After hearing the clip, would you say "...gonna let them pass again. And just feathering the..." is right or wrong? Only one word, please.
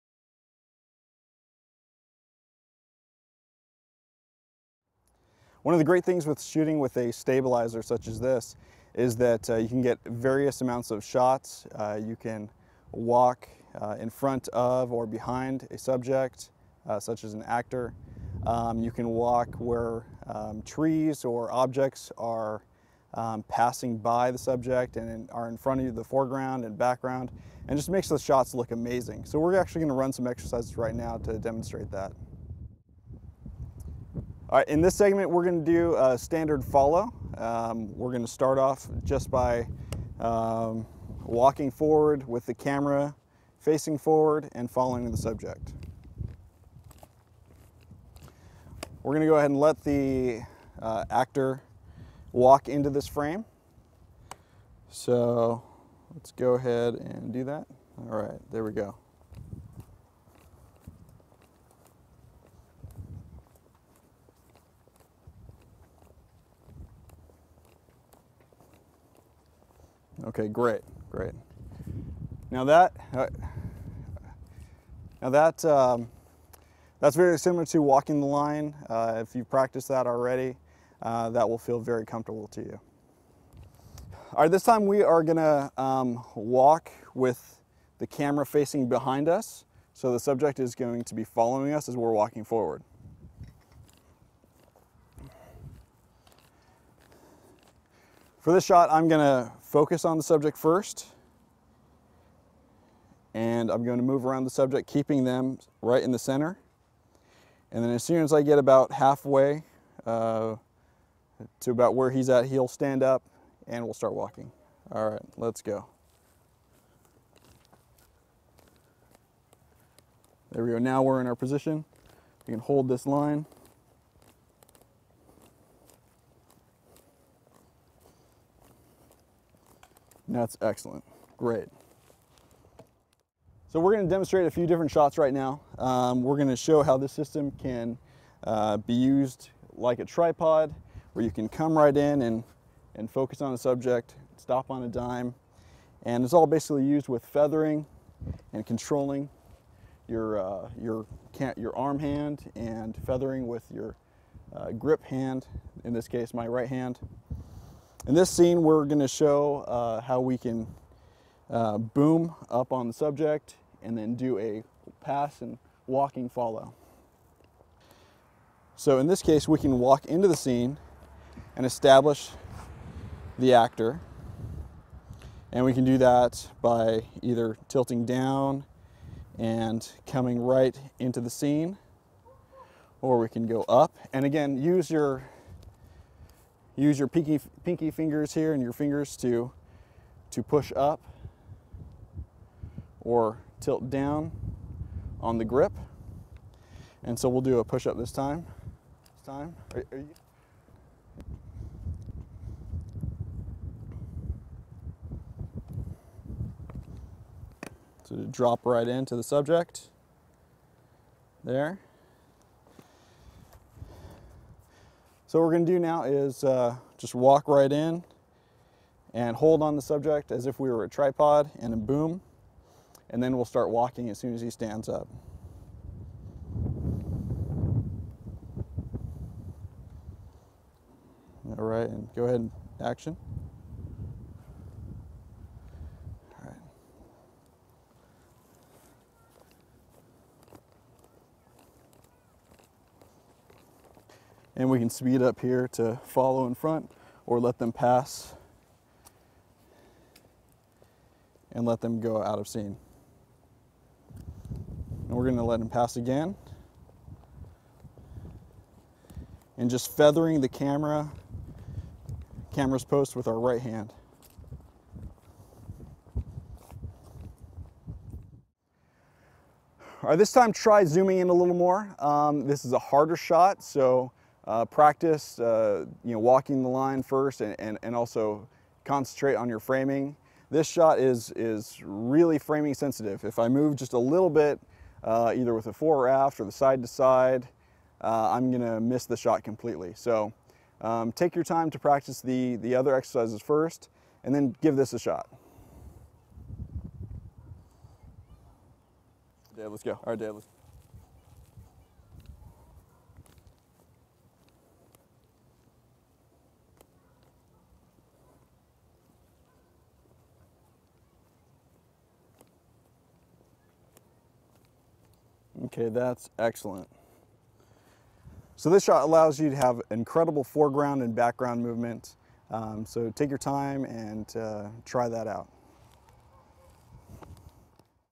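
right.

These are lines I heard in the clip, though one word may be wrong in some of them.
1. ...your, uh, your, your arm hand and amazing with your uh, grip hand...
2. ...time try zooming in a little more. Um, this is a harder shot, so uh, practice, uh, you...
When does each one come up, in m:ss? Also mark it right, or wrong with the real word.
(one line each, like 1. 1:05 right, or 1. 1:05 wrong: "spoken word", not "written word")
1. 2:30 wrong: "feathering", not "amazing"
2. 4:30 right.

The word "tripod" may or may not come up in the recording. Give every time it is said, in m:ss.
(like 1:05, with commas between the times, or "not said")
2:20, 3:40.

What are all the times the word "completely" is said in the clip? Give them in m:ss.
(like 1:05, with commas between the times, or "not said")
4:49.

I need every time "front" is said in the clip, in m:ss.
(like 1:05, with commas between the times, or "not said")
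0:14, 0:25, 4:06.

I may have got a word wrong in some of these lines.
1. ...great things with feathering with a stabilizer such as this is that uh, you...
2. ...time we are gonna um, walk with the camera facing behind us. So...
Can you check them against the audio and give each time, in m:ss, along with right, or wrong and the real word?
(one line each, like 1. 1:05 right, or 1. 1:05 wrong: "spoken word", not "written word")
1. 0:05 wrong: "shooting", not "feathering"
2. 1:24 right.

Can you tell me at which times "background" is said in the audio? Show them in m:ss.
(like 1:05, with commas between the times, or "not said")
0:26, 5:21.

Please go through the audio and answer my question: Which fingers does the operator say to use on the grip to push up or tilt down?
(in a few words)
pinky fingers.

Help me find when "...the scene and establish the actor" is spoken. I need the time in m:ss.
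2:50.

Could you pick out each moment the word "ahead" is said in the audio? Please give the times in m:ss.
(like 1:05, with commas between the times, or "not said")
0:49, 0:56, 3:52.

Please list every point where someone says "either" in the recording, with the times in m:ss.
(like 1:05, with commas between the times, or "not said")
2:57, 4:45.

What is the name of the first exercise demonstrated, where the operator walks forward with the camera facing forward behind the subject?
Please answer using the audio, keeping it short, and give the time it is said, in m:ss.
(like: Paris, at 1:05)
standard follow, at 0:36.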